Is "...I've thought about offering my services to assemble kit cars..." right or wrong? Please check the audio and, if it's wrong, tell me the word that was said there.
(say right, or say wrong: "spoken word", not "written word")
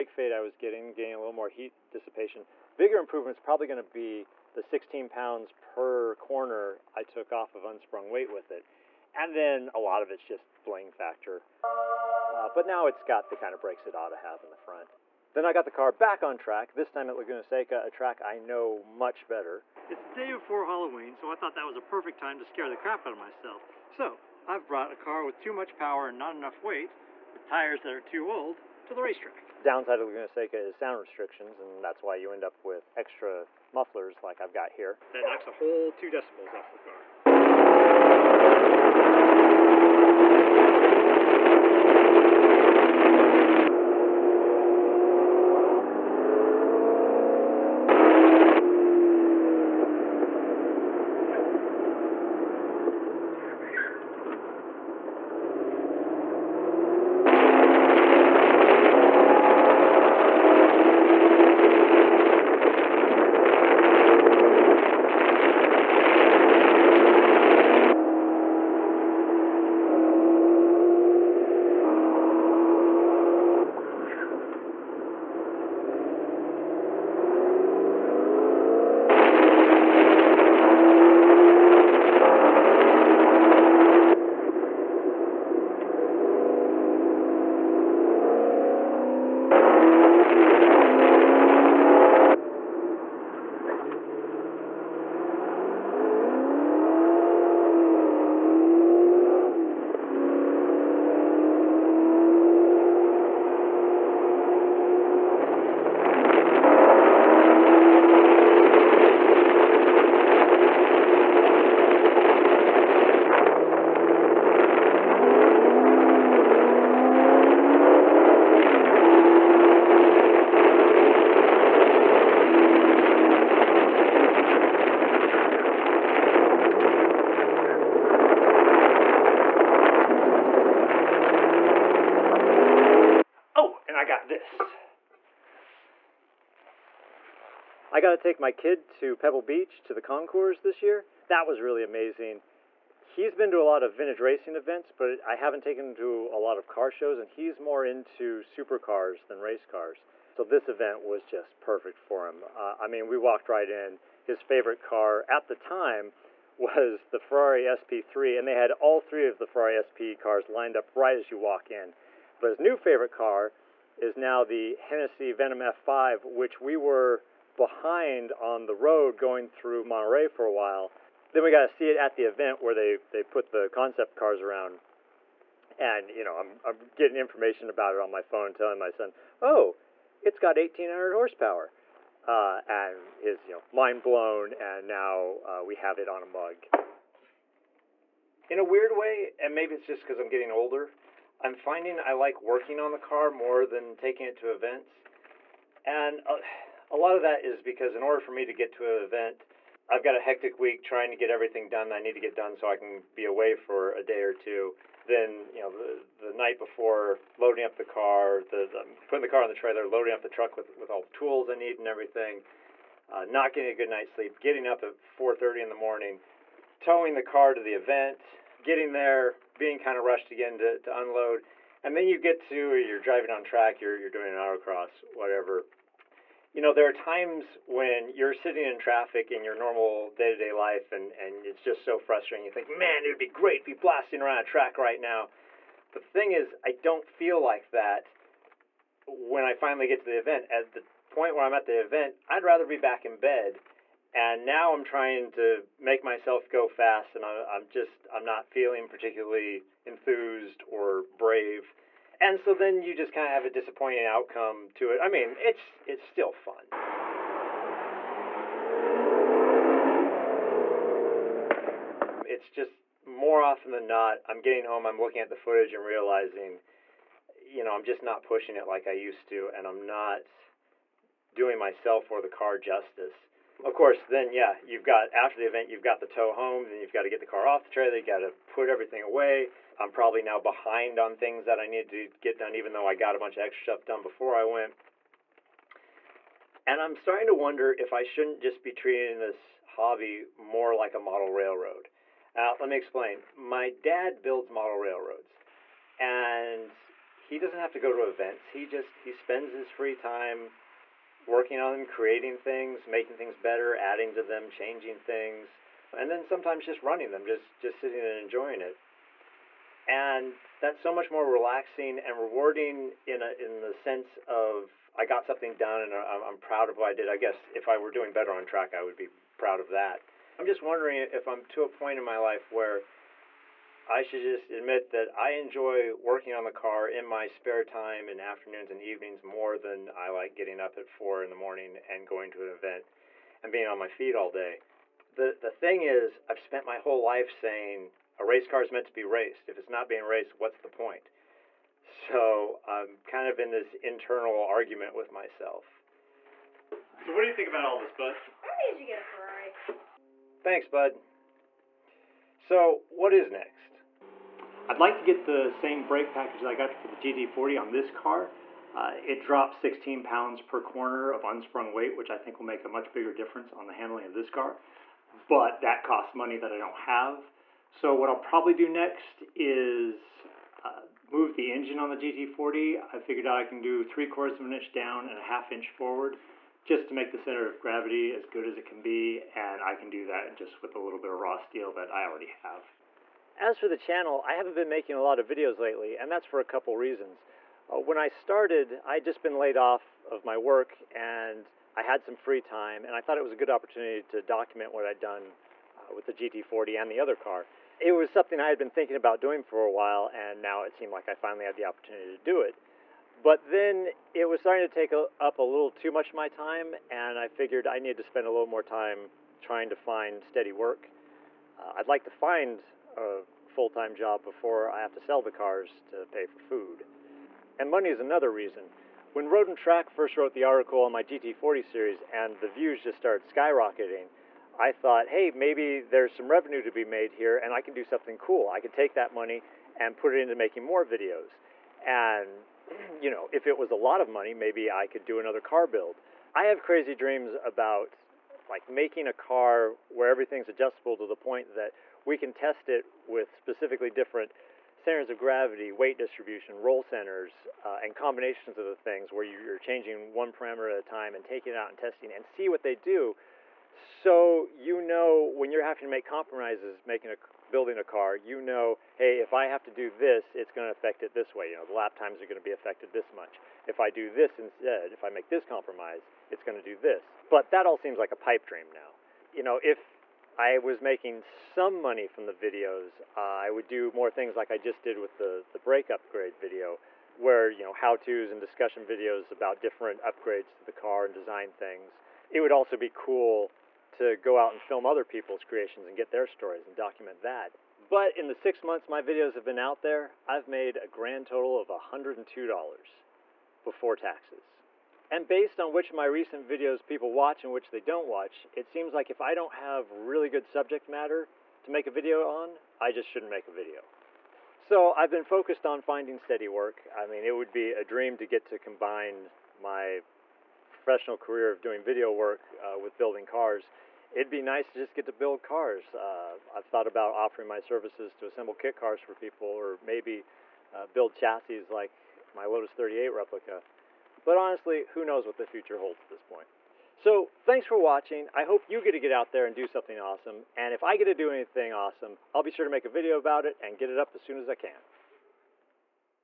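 right.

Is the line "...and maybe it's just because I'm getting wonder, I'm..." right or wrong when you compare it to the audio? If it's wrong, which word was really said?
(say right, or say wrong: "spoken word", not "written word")
wrong: "older", not "wonder".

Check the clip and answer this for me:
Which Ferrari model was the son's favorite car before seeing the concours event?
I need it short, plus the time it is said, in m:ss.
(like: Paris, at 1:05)
Ferrari SP3, at 2:37.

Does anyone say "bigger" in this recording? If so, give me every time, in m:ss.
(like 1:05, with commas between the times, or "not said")
0:02, 6:02.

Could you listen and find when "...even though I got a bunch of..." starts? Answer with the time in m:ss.
4:42.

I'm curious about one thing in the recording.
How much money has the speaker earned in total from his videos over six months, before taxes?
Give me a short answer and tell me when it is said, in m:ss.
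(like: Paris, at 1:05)
$102, at 8:11.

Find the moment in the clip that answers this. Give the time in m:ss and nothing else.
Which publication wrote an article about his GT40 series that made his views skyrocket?
6:59.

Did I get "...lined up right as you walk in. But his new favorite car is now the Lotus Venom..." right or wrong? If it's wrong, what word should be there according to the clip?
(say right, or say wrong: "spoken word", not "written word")
wrong: "Hennessy", not "Lotus".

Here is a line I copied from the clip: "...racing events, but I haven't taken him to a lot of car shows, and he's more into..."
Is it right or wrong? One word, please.
right.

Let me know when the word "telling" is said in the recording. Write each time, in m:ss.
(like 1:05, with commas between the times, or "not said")
2:58.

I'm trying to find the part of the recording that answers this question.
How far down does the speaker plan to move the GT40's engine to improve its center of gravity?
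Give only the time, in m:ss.
6:13.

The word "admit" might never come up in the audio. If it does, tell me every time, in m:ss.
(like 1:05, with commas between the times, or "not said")
5:24.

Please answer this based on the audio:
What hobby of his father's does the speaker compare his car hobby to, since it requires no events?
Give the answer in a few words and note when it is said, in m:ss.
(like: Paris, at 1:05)
model railroads, at 4:54.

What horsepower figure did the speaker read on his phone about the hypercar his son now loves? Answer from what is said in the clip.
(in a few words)
1,800.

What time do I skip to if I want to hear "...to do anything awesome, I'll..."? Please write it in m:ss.
8:51.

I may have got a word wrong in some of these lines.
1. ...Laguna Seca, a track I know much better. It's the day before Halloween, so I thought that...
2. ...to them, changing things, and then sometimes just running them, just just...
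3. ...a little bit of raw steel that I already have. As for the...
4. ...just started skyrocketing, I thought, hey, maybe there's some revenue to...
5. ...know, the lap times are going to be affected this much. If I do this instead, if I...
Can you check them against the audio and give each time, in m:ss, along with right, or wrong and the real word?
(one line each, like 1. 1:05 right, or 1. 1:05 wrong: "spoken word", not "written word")
1. 0:17 right
2. 5:04 right
3. 6:20 right
4. 7:02 right
5. 7:41 right.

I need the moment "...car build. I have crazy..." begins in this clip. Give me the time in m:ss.
7:15.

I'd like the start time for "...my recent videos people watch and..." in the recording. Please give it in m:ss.
8:15.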